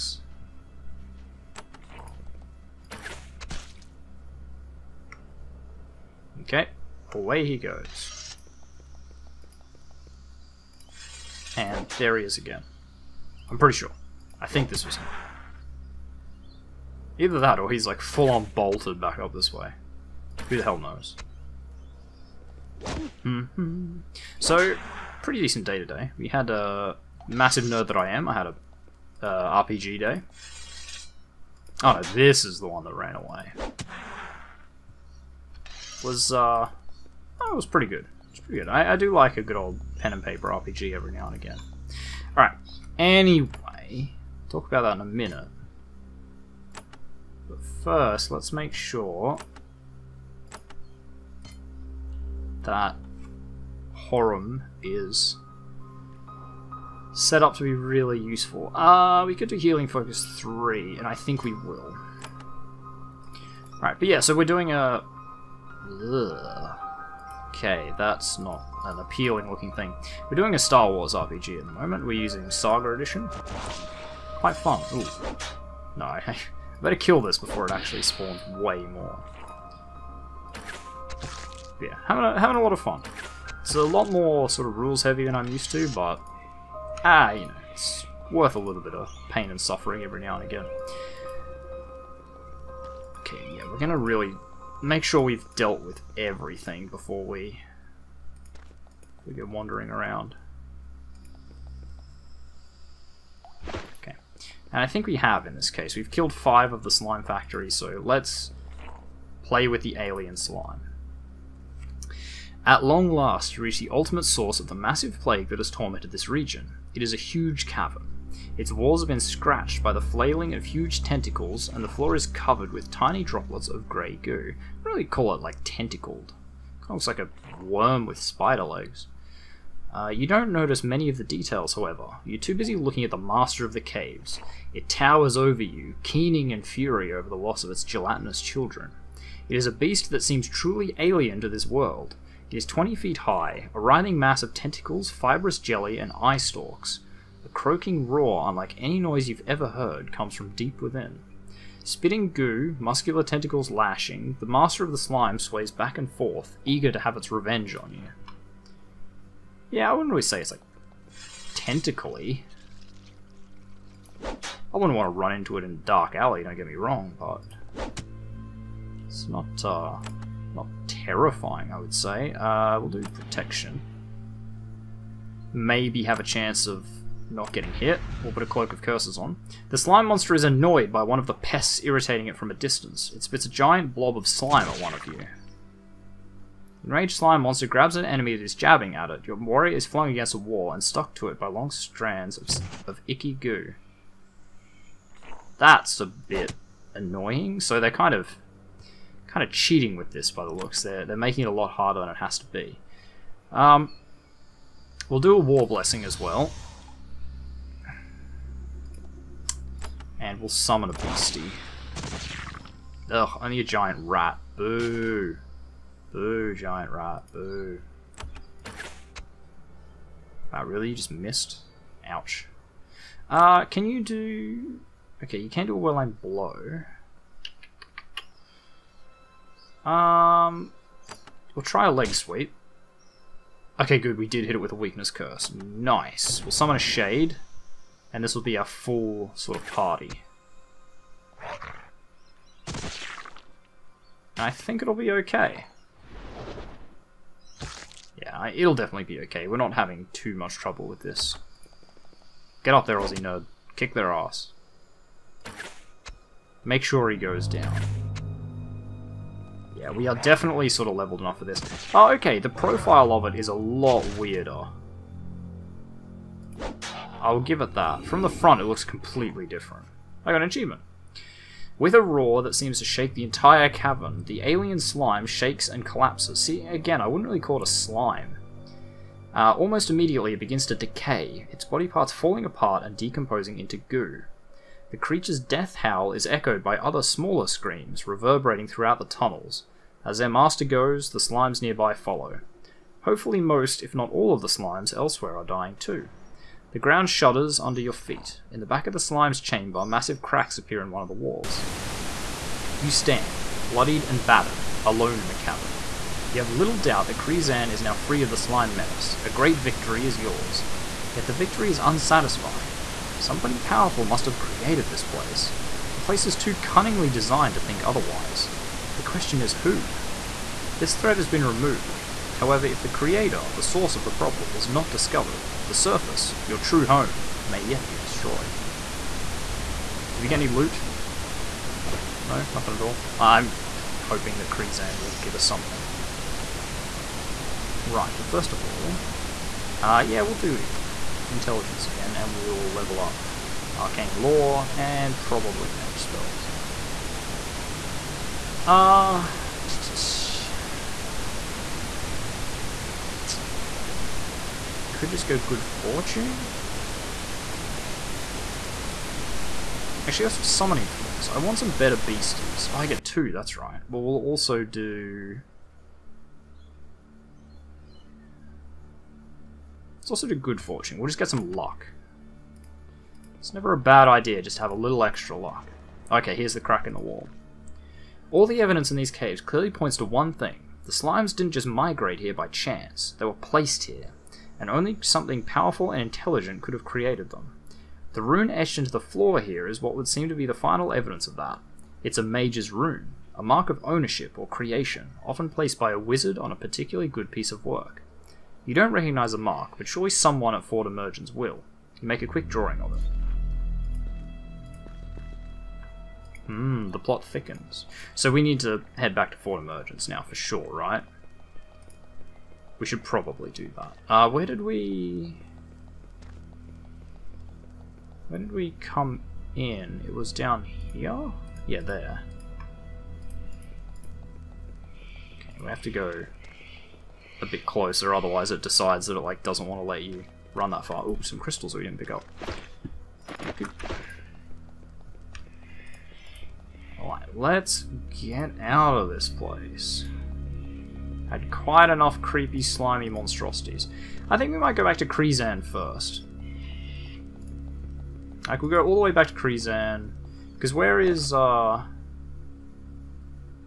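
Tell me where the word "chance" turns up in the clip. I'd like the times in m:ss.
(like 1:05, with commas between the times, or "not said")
2:56, 6:22.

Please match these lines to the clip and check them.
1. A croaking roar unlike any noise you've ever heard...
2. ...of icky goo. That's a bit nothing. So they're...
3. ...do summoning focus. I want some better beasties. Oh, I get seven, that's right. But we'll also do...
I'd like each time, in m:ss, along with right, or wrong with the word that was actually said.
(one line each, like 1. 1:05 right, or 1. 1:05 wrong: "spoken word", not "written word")
1. 2:27 right
2. 3:12 wrong: "annoying", not "nothing"
3. 6:00 wrong: "two", not "seven".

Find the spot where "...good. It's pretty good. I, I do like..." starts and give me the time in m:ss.
0:37.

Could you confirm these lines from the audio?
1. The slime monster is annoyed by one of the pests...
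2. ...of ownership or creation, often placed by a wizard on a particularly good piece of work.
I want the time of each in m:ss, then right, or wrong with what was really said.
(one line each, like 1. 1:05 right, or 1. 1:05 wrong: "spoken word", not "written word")
1. 2:59 right
2. 6:33 right.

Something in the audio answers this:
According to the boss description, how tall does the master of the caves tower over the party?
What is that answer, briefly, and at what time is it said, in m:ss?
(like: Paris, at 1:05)
20 feet, at 2:22.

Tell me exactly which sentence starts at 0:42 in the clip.
Alright, anyway, talk about that in a minute.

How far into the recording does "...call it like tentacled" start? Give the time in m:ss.
2:05.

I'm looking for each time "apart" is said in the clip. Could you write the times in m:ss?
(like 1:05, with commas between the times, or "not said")
4:42.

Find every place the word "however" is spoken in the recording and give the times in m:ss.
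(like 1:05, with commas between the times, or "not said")
2:11, 5:22.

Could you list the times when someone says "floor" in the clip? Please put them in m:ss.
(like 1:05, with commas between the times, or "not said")
2:01, 6:28.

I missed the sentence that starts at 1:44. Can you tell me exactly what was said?
Okay, and I think we have in this case.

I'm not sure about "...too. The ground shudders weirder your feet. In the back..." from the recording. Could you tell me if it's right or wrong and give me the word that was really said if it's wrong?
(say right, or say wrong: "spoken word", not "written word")
wrong: "under", not "weirder".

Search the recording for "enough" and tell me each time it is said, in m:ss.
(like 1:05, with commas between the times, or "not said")
4:21, 7:21.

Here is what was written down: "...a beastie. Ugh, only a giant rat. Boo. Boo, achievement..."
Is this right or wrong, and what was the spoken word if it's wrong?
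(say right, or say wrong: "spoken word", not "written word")
wrong: "giant", not "achievement".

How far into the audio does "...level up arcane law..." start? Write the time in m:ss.
5:42.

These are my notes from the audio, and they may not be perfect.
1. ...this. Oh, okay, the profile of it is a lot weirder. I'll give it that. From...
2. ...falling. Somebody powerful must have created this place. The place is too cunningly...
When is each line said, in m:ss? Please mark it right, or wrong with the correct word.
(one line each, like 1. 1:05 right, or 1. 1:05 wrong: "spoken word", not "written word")
1. 4:21 right
2. 5:11 wrong: "unsatisfying", not "falling".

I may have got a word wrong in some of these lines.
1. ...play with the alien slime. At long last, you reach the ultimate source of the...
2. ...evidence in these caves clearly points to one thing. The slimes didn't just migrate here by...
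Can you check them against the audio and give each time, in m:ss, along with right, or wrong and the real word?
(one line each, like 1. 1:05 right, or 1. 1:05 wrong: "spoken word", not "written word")
1. 1:49 right
2. 6:18 right.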